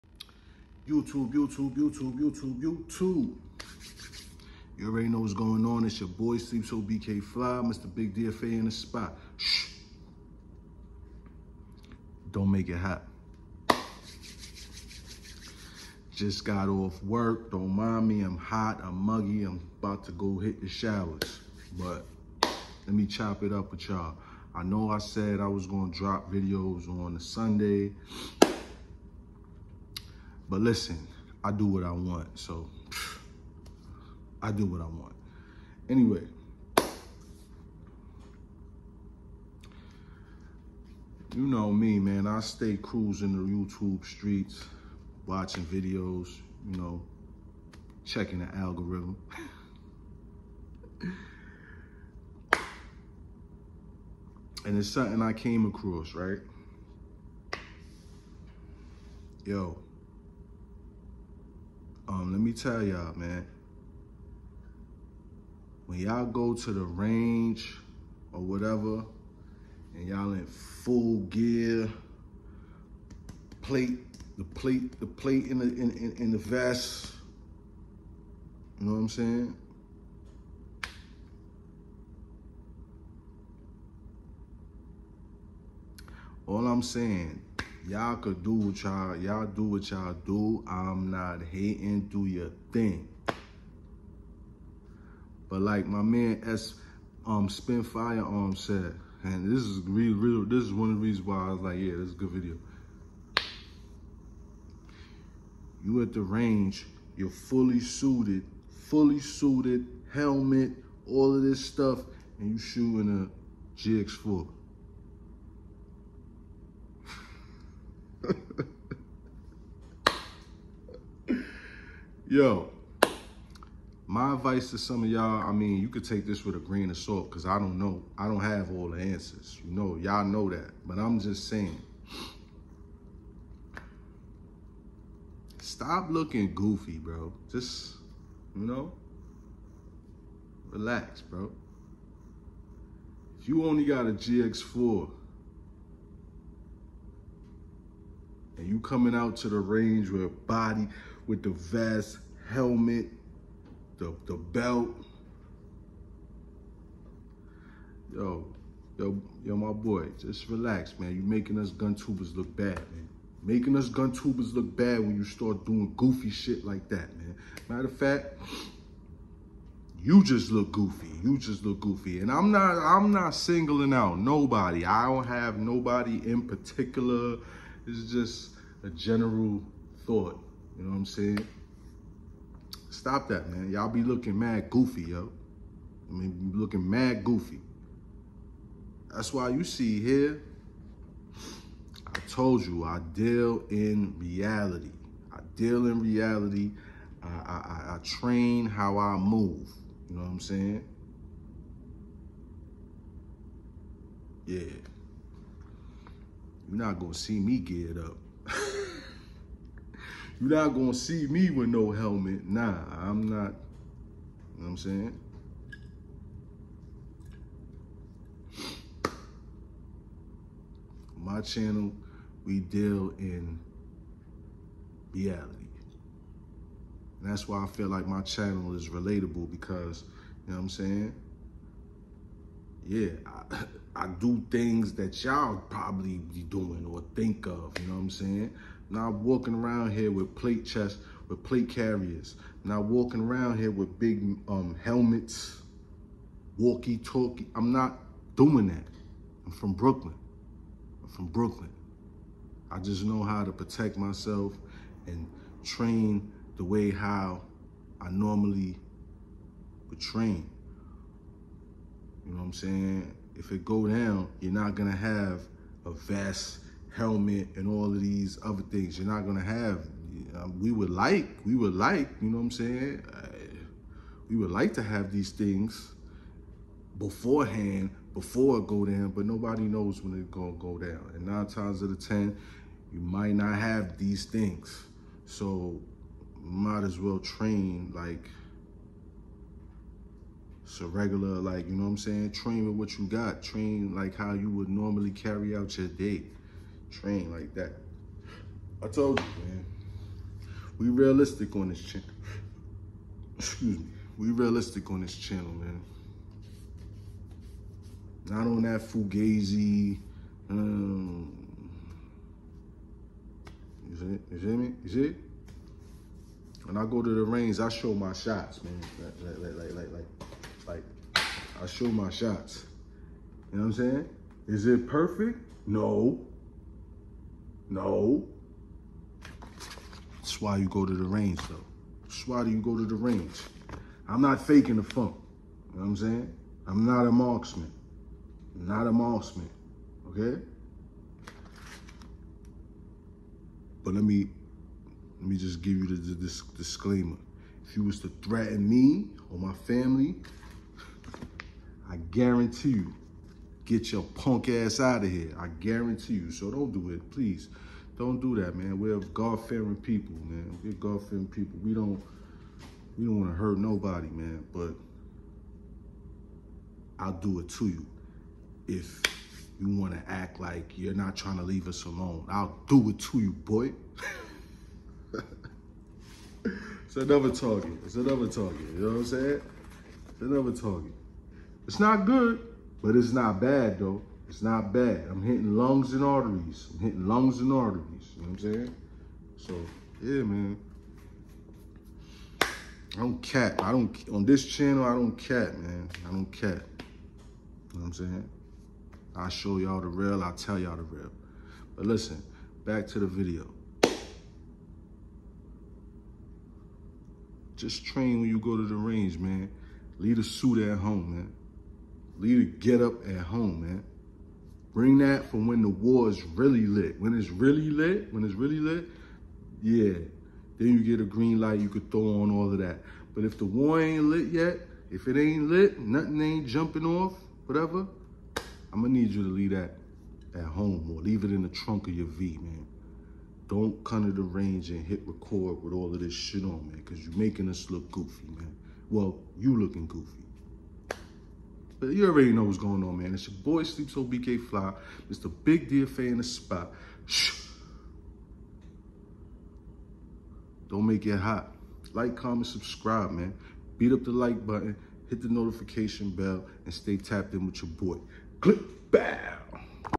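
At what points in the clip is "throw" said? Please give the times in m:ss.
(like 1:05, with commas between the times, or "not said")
7:01.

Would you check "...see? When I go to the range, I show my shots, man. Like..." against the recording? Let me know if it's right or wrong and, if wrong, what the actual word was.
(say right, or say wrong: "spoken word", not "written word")
right.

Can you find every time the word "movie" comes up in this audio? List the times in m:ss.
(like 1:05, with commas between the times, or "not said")
not said.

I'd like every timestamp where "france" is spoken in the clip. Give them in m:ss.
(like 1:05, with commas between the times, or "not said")
not said.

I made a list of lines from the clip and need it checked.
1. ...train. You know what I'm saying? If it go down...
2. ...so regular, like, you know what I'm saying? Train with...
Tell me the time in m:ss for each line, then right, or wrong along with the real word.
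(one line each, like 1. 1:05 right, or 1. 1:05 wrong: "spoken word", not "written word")
1. 4:20 right
2. 4:50 right.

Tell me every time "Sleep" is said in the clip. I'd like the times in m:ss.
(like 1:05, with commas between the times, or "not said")
0:06, 7:23.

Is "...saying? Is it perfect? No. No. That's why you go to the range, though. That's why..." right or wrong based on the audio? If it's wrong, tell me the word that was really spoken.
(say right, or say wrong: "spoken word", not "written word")
right.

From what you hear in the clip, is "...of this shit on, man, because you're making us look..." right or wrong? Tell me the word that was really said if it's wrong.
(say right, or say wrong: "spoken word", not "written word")
right.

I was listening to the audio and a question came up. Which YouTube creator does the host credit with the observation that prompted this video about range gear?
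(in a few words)
Spin Firearm.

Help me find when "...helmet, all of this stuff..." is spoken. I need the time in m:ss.
1:50.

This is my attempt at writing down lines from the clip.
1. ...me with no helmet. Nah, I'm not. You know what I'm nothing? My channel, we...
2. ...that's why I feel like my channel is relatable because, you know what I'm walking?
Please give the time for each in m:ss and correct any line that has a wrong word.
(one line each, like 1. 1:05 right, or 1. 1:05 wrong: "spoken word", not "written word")
1. 3:31 wrong: "saying", not "nothing"
2. 3:47 wrong: "saying", not "walking".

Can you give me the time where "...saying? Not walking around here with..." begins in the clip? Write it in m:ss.
3:58.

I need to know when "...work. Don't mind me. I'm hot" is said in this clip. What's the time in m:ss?
0:17.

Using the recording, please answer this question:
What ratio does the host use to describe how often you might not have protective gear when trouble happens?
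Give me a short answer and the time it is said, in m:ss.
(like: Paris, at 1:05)
9 times out of 10, at 4:41.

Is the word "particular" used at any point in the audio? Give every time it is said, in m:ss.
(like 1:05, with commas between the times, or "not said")
2:56.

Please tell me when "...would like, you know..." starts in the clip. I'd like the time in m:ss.
4:31.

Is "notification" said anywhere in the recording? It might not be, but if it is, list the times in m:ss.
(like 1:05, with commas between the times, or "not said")
7:35.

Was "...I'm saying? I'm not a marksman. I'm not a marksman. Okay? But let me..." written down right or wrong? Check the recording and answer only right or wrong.
right.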